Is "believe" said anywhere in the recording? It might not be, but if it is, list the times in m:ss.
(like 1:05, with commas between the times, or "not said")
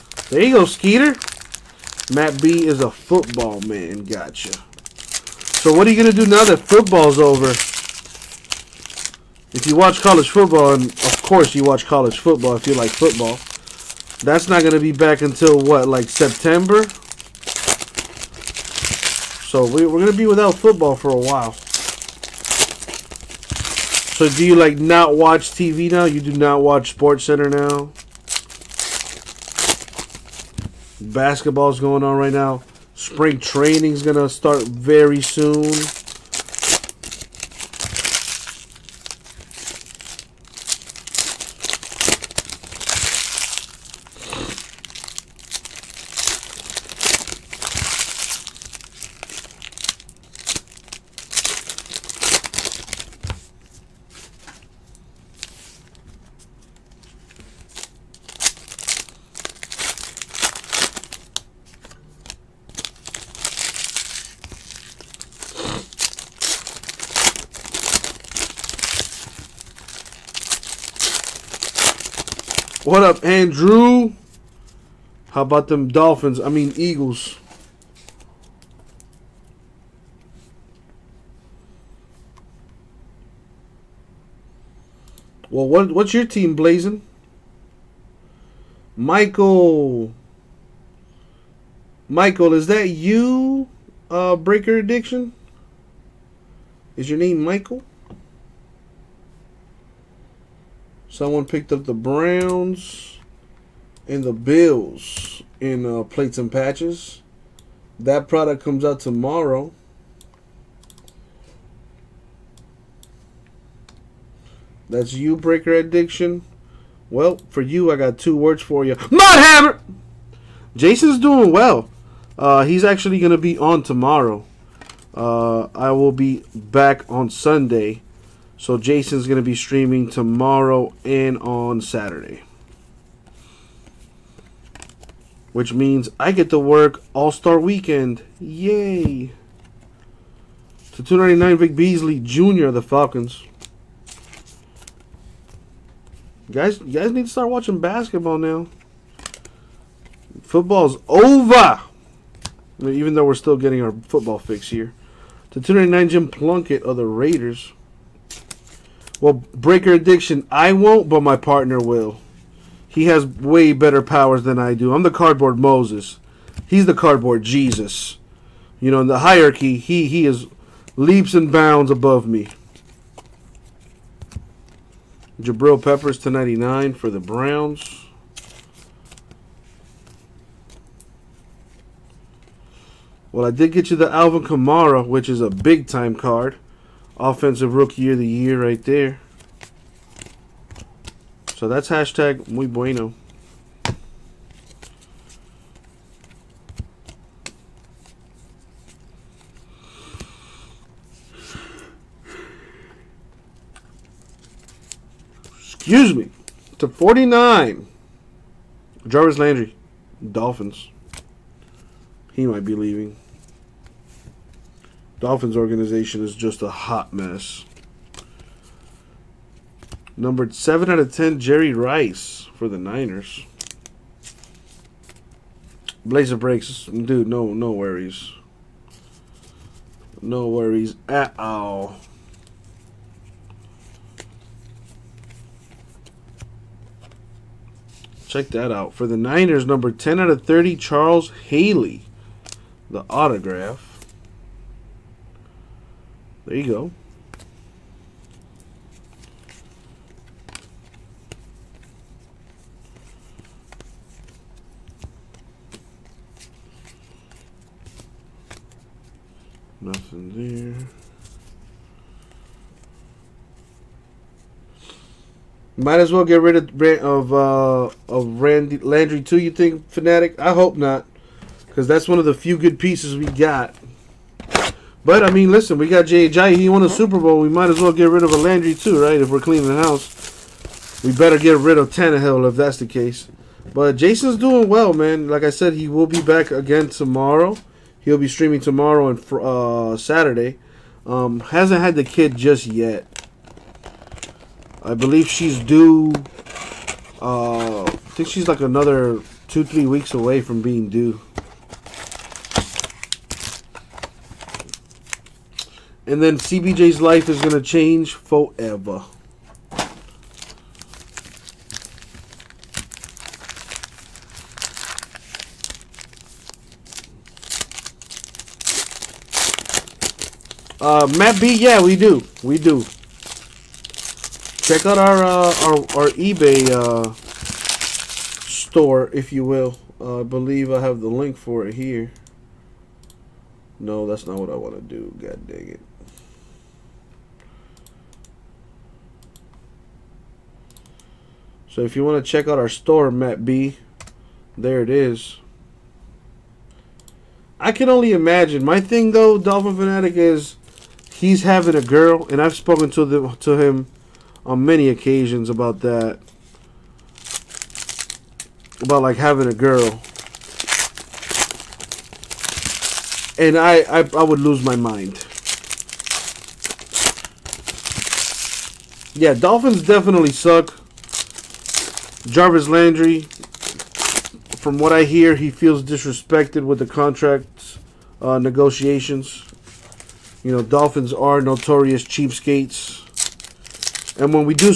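4:54, 5:30.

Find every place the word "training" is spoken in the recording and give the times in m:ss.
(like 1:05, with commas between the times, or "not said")
0:33.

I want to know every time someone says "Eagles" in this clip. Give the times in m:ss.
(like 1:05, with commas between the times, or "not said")
1:16.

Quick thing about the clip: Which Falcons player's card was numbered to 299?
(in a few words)
Vic Beasley Jr.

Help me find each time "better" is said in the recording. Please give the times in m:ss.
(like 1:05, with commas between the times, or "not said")
2:43, 4:41.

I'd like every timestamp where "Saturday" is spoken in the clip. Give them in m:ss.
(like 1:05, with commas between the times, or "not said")
2:11, 4:49.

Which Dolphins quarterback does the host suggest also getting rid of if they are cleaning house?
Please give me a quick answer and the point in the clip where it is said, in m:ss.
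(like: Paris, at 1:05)
Tannehill, at 4:41.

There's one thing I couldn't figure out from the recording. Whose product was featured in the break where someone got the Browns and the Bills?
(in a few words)
Plates and Patches.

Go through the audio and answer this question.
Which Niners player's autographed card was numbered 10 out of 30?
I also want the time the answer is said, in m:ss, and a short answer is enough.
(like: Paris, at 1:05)
Charles Haley, at 4:00.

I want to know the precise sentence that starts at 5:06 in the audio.
And then CBJ's life is going to change forever.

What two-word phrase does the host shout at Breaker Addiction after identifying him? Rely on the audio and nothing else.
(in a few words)
Mud Hammer.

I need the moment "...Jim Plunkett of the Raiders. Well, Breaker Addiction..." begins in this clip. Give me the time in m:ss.
2:36.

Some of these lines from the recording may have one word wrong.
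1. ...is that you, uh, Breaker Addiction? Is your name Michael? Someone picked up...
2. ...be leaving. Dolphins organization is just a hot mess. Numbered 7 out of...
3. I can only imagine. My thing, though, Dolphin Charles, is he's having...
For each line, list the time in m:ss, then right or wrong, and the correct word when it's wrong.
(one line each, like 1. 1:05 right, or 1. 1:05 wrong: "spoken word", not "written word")
1. 1:32 right
2. 3:32 right
3. 5:47 wrong: "Fanatic", not "Charles".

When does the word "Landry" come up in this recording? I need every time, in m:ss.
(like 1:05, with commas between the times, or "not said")
3:29, 4:28, 4:38, 6:12.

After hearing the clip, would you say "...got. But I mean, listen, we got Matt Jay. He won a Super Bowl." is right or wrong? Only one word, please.
wrong.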